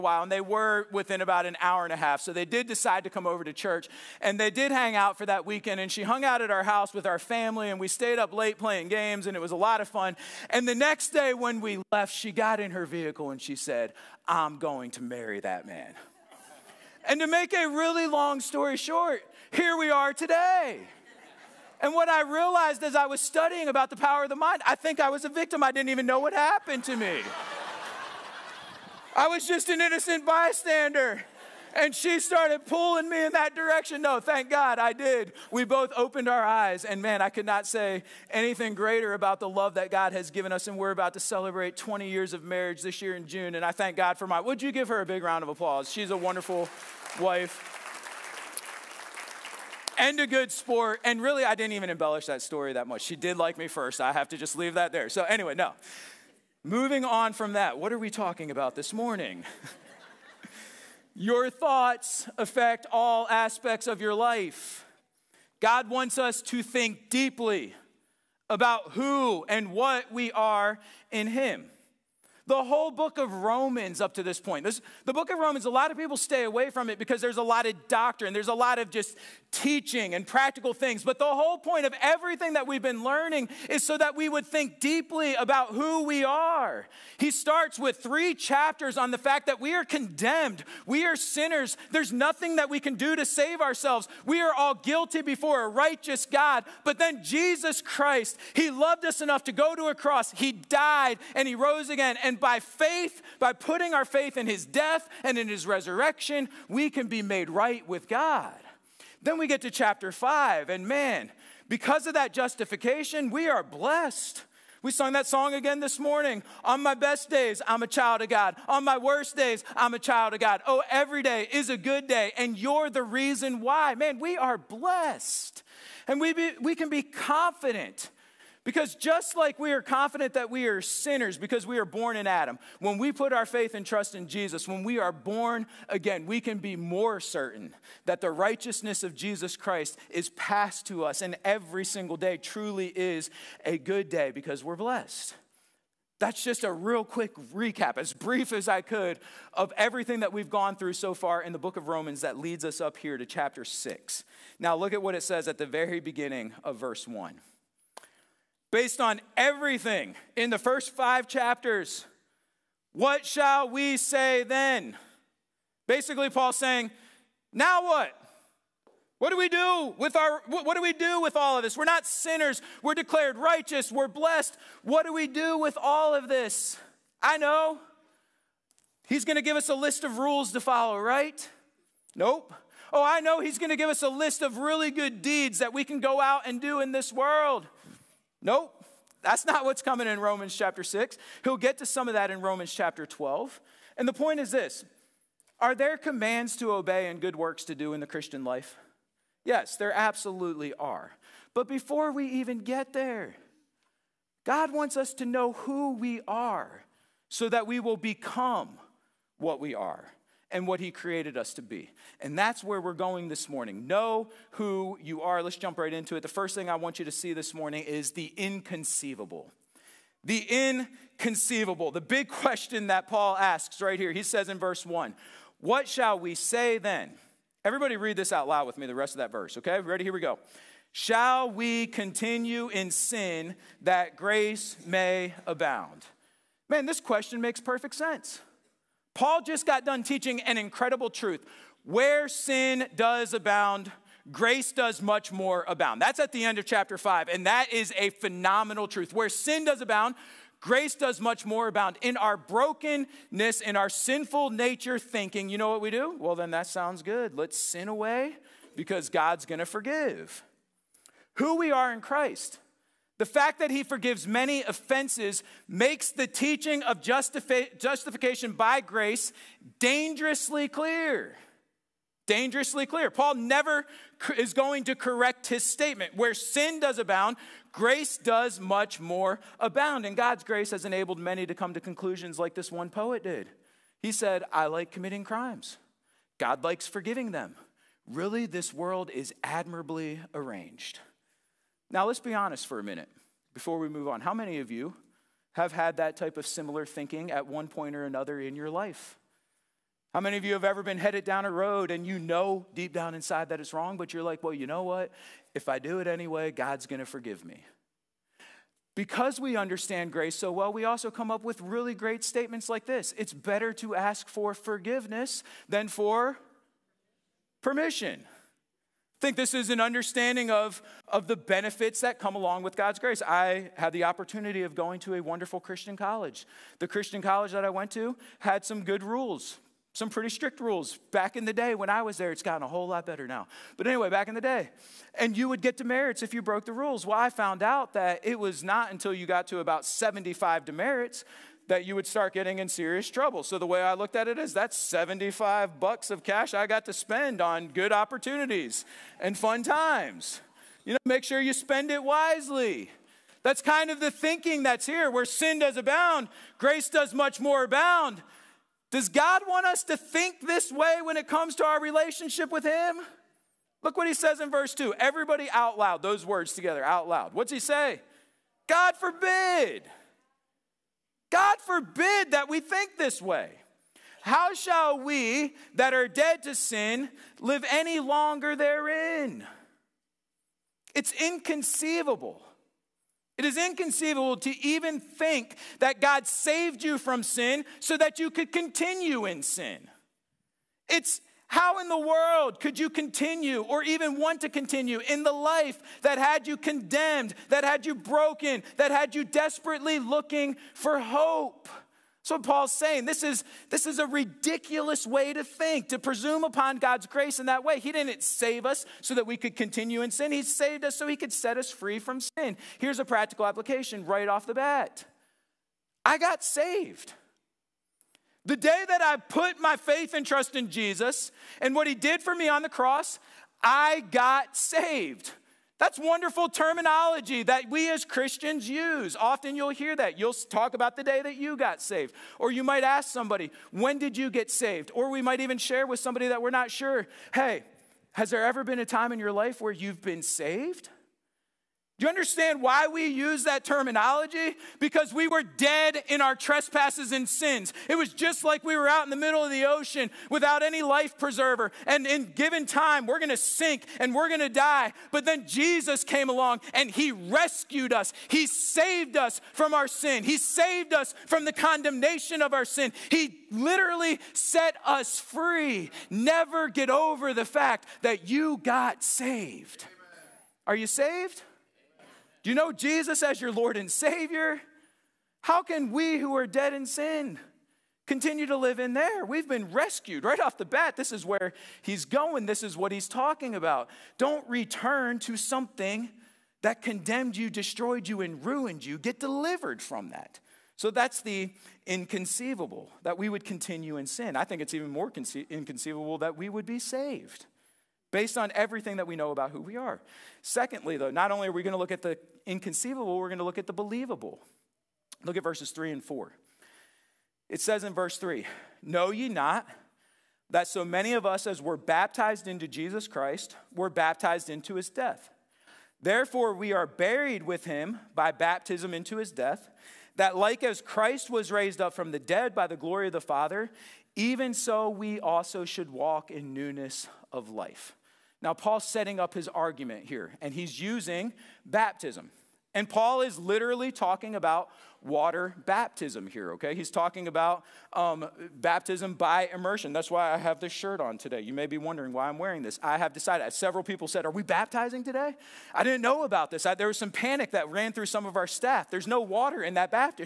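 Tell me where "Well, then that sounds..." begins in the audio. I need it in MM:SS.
04:16.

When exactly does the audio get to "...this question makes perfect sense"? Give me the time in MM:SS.
03:56.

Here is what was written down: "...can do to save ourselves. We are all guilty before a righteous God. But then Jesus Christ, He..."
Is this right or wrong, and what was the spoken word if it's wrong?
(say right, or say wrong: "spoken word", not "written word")
right.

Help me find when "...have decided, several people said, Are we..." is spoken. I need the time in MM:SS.
09:02.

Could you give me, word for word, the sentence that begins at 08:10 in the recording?
So that's the inconceivable that we would continue in sin.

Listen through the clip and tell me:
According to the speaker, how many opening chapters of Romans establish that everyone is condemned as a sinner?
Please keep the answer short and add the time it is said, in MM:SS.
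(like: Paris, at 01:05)
3, at 01:27.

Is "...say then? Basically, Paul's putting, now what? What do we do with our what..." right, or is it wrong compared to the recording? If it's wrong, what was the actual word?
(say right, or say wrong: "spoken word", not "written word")
wrong: "saying", not "putting".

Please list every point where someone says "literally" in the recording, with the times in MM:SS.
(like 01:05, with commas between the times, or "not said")
07:43, 08:53.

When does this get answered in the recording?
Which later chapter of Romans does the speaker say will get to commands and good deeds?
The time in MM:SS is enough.
03:12.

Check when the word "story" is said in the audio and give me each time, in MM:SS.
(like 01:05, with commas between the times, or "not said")
00:18, 00:52.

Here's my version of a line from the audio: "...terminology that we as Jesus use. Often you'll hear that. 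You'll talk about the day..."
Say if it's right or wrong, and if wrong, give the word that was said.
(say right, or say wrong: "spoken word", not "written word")
wrong: "Christians", not "Jesus".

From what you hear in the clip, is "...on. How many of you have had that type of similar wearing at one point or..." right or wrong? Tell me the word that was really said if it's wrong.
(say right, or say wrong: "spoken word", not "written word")
wrong: "thinking", not "wearing".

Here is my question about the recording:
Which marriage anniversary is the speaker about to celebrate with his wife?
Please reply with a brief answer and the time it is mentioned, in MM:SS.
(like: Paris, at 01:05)
20 years, at 00:41.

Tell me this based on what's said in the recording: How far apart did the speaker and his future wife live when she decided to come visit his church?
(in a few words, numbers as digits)
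About an hour and a half.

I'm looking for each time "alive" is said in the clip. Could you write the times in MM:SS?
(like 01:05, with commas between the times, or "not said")
not said.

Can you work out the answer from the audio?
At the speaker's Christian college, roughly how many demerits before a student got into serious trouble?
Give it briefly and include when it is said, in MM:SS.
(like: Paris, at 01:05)
75, at 05:39.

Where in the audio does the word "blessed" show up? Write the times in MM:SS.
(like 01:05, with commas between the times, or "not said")
01:53, 02:04, 02:24, 02:54.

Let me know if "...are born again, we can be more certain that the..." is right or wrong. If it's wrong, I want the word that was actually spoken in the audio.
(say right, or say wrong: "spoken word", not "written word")
right.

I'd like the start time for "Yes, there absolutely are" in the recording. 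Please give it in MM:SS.
03:19.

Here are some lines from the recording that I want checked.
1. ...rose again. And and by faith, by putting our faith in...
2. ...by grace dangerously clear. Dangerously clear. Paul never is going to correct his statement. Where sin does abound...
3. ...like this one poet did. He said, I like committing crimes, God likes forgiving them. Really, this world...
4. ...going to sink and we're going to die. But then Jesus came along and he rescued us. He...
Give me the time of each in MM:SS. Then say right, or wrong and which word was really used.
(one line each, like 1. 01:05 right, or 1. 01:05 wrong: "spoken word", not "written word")
1. 01:41 right
2. 04:28 right
3. 04:42 right
4. 07:33 right.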